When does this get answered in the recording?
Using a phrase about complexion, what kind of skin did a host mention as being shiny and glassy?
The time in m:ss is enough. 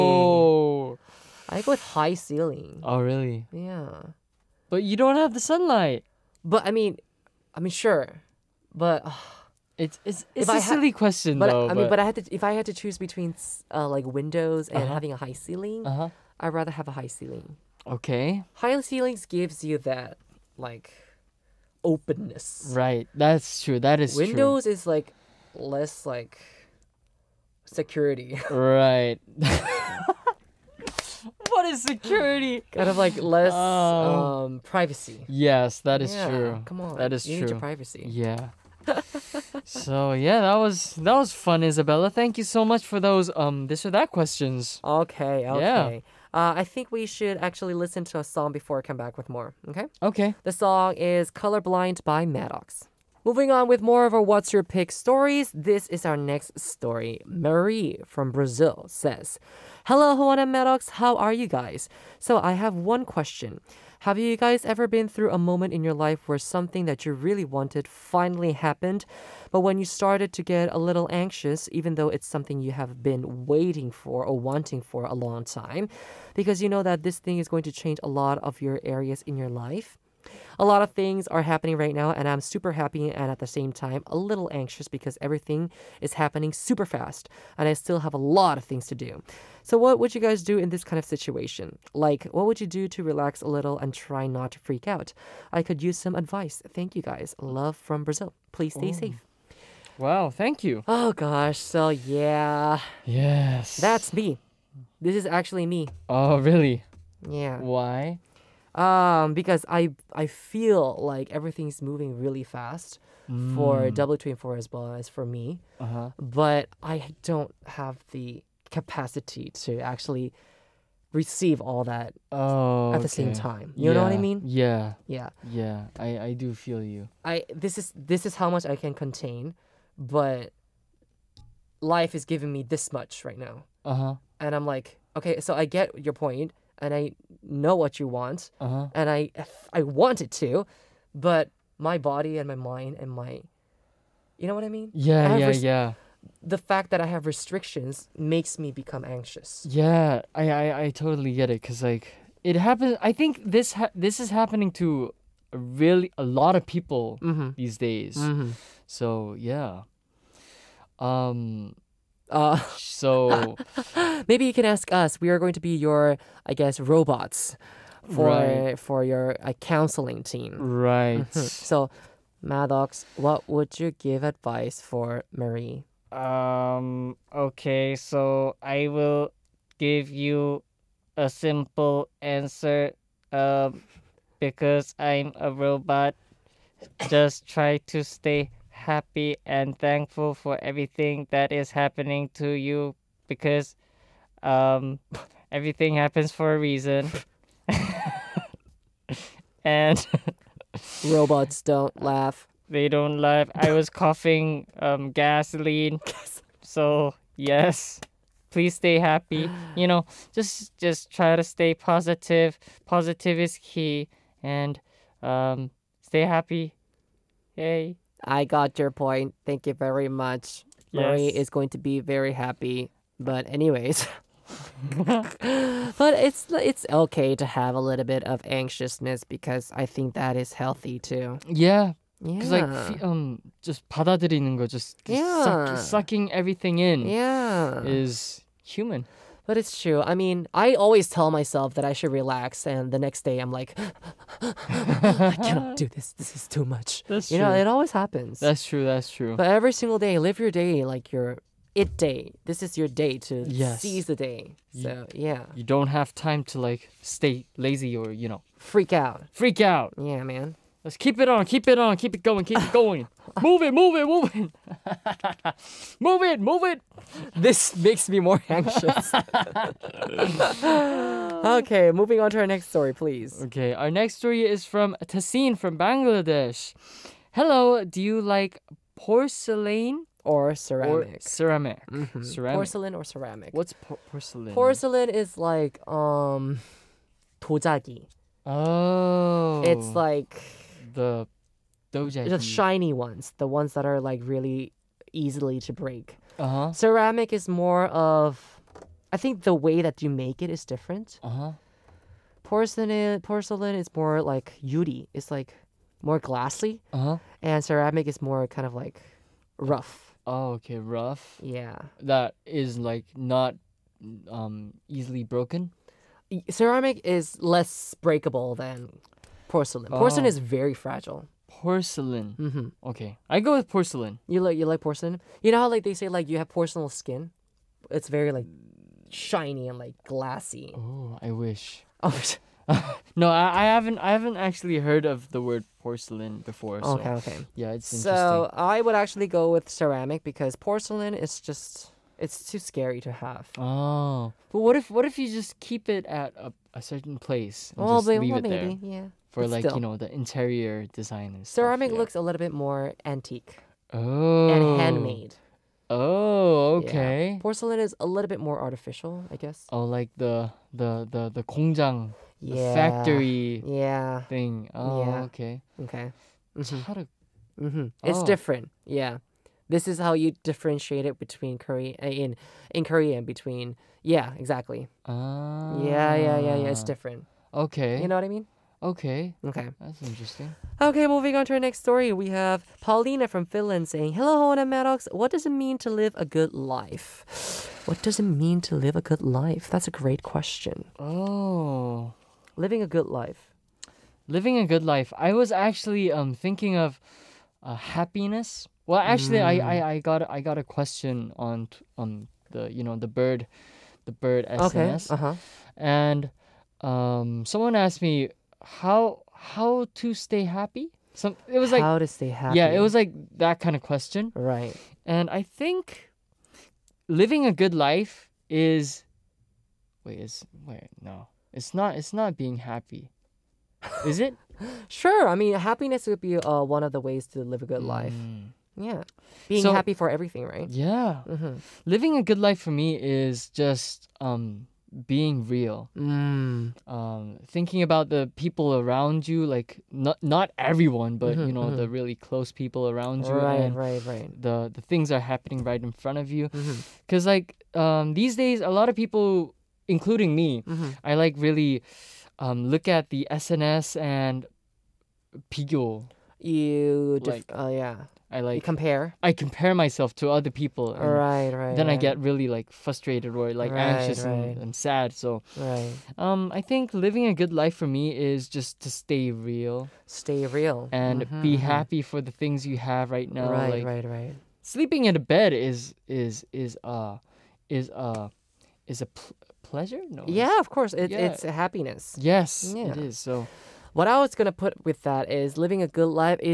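5:26.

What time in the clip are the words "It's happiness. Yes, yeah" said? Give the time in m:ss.
8:01.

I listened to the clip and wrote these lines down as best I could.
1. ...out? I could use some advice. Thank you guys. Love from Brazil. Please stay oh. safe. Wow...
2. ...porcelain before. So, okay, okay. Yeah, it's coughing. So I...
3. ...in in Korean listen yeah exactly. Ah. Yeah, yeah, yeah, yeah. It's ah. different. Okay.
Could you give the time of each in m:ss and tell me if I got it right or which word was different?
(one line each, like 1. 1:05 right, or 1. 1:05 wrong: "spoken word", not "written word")
1. 1:34 right
2. 5:35 wrong: "interesting", not "coughing"
3. 6:12 wrong: "between", not "listen".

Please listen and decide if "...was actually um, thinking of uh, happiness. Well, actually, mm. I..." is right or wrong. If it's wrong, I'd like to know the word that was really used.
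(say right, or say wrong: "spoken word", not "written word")
right.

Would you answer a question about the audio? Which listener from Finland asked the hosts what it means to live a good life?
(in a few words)
Paulina.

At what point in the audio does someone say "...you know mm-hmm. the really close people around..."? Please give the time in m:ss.
7:21.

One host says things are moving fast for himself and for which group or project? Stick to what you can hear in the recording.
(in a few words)
W24.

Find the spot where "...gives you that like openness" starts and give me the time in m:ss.
0:19.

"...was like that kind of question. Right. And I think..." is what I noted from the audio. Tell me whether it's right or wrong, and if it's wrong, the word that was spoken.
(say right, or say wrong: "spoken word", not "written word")
right.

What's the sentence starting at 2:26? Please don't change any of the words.
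The fact that I have restrictions makes me become anxious.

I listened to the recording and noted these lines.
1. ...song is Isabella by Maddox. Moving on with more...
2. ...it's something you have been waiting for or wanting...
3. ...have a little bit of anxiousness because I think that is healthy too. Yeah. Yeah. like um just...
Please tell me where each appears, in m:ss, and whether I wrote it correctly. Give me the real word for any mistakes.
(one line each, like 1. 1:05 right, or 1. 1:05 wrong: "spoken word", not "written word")
1. 0:50 wrong: "Colorblind", not "Isabella"
2. 1:12 right
3. 3:47 right.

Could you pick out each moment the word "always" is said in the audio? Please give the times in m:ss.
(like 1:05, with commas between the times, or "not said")
4:00, 4:07.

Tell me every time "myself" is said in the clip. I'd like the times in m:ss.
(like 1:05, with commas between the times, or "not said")
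4:01, 7:39.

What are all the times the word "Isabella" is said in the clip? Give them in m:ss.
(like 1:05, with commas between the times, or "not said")
0:41.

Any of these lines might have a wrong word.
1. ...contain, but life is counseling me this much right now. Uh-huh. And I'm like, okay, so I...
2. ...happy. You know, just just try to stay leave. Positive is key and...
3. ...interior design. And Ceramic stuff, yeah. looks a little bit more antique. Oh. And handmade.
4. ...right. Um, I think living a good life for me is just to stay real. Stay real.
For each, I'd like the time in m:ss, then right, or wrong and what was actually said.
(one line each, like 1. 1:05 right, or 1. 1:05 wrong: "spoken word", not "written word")
1. 2:08 wrong: "giving", not "counseling"
2. 3:28 wrong: "positive", not "leave"
3. 5:50 right
4. 7:45 right.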